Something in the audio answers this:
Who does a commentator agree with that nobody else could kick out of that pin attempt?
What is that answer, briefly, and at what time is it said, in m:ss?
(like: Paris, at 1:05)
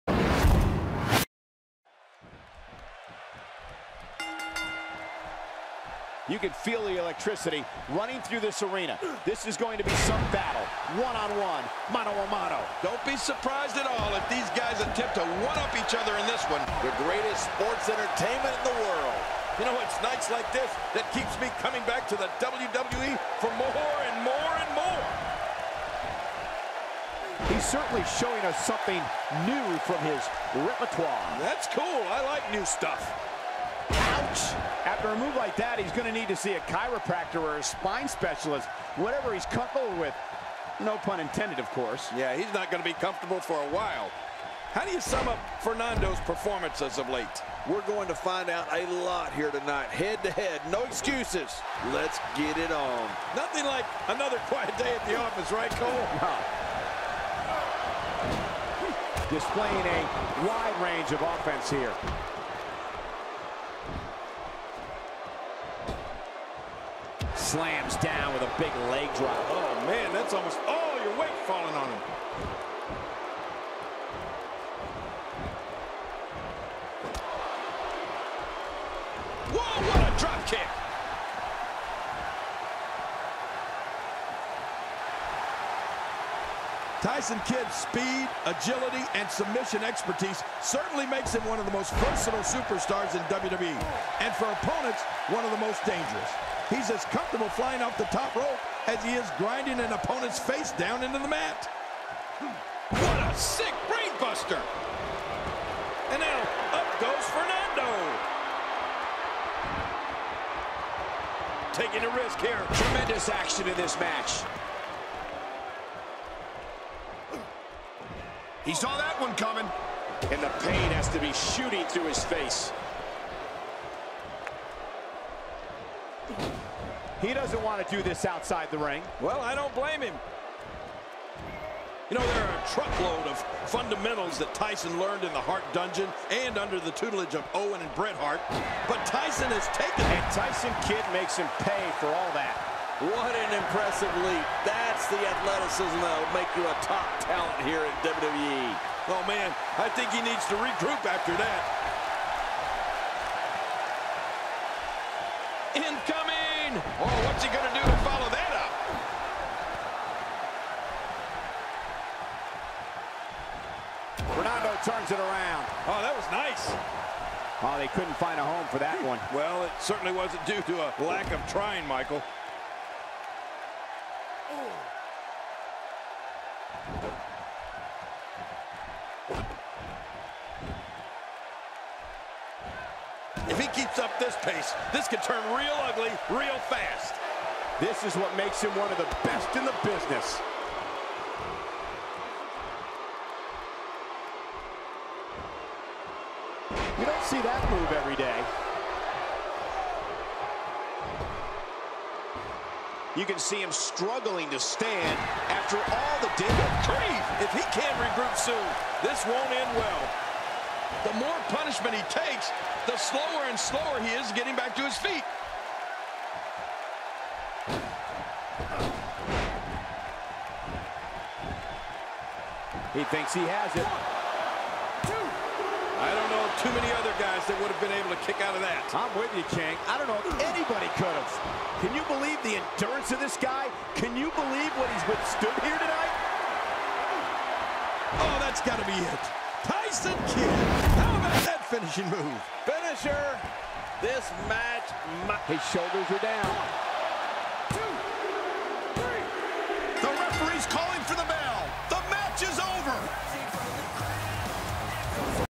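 Chang, at 3:49.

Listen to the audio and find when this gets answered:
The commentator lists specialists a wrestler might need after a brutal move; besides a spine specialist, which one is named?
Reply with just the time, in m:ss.
0:36.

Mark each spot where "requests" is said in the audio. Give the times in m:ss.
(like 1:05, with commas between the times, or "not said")
not said.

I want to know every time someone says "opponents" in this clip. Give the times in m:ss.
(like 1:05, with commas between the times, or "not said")
1:34, 1:39.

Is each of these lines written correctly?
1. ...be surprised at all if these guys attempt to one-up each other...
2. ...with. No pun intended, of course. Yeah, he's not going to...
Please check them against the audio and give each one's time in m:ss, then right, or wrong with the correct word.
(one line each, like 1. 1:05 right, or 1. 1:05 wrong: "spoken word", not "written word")
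1. 0:13 right
2. 0:39 right.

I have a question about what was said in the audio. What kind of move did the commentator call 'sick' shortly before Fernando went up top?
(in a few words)
Brainbuster.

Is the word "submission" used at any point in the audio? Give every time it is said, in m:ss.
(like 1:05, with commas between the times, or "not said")
1:29.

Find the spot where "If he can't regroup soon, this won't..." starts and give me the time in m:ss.
3:27.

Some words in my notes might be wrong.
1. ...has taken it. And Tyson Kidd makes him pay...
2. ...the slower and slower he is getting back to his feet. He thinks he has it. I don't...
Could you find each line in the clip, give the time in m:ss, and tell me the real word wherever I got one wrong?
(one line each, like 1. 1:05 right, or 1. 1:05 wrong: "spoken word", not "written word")
1. 2:19 right
2. 3:32 right.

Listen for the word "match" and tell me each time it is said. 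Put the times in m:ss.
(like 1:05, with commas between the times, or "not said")
1:53, 4:04.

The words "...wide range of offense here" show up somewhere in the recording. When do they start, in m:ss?
1:00.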